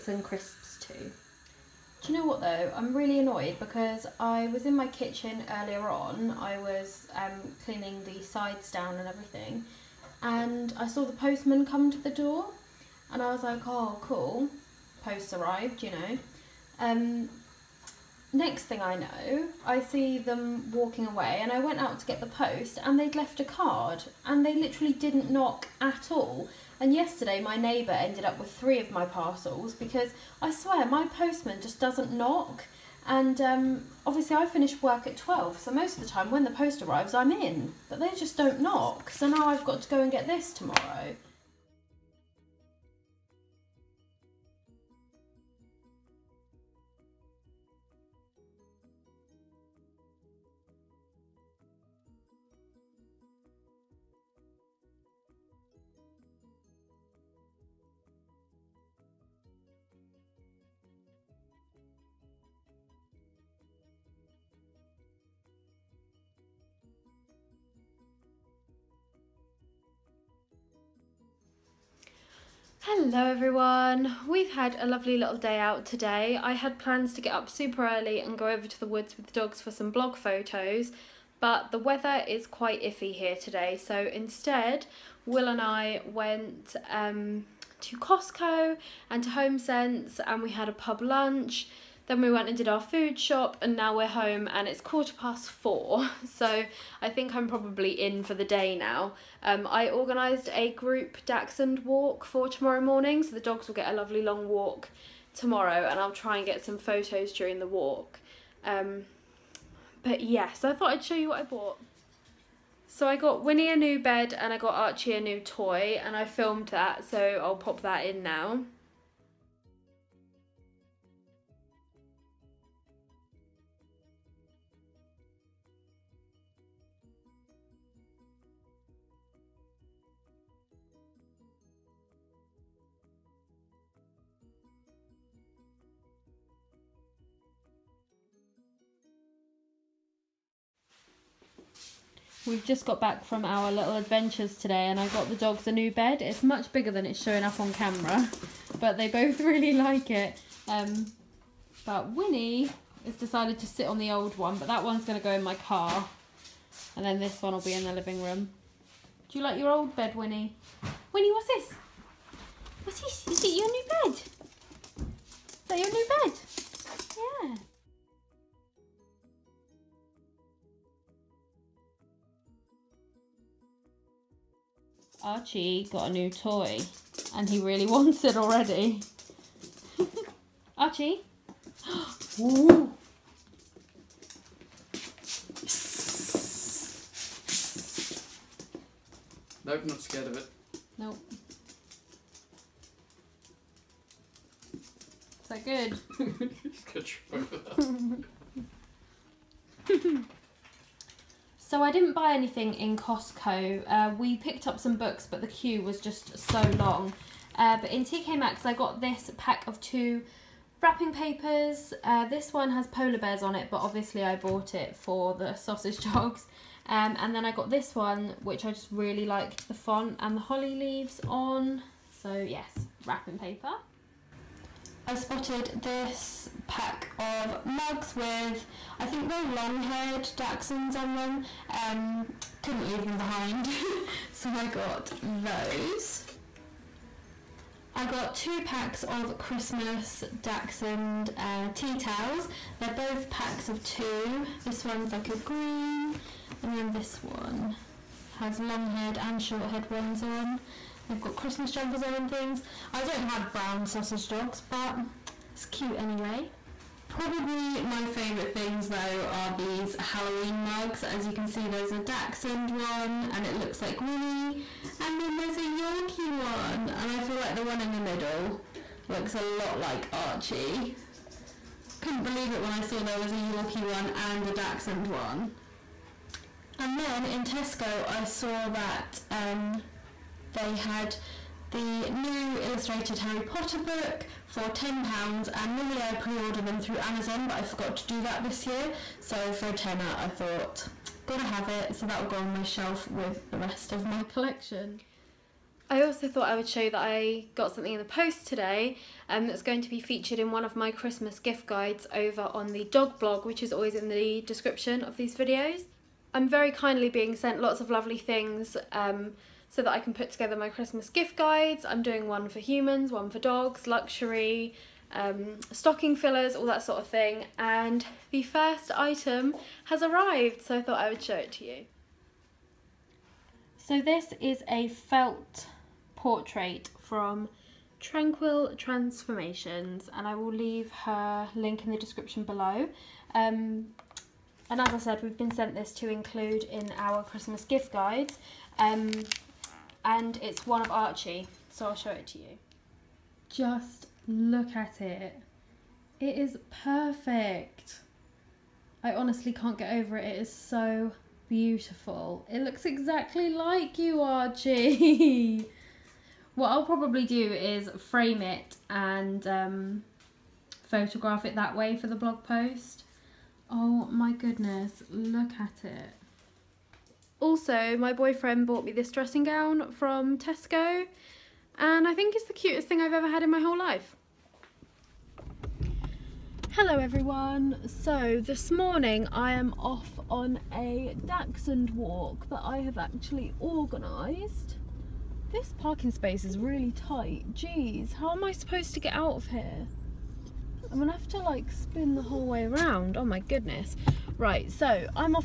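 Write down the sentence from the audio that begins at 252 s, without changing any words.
I don't have brown sausage dogs, but it's cute anyway.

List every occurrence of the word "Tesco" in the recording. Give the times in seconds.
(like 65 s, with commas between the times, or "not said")
277 s, 370 s.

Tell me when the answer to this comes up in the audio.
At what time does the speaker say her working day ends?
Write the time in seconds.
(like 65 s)
35 s.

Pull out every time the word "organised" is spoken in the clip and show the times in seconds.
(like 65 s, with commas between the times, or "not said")
99 s, 383 s.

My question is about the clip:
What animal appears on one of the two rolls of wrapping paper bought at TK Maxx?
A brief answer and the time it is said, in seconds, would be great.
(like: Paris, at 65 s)
Polar bears, at 212 s.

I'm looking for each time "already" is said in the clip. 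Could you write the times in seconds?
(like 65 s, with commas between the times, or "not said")
178 s.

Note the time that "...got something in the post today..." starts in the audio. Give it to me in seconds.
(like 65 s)
297 s.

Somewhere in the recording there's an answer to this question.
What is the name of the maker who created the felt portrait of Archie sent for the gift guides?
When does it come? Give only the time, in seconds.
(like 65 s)
328 s.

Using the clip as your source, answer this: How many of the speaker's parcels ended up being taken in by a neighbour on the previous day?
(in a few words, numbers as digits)
3.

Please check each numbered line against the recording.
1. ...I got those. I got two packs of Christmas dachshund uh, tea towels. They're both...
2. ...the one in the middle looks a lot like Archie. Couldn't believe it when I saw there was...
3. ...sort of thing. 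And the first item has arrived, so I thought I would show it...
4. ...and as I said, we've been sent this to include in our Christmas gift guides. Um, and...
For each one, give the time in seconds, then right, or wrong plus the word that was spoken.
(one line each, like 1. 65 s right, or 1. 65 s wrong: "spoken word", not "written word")
1. 234 s right
2. 267 s right
3. 316 s right
4. 334 s right.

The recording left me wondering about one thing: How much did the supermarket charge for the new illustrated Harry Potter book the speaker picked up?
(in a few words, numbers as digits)
£10.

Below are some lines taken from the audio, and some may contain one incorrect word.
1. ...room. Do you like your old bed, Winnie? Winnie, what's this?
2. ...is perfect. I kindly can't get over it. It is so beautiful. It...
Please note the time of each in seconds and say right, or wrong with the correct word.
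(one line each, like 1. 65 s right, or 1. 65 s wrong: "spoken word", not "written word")
1. 158 s right
2. 346 s wrong: "honestly", not "kindly".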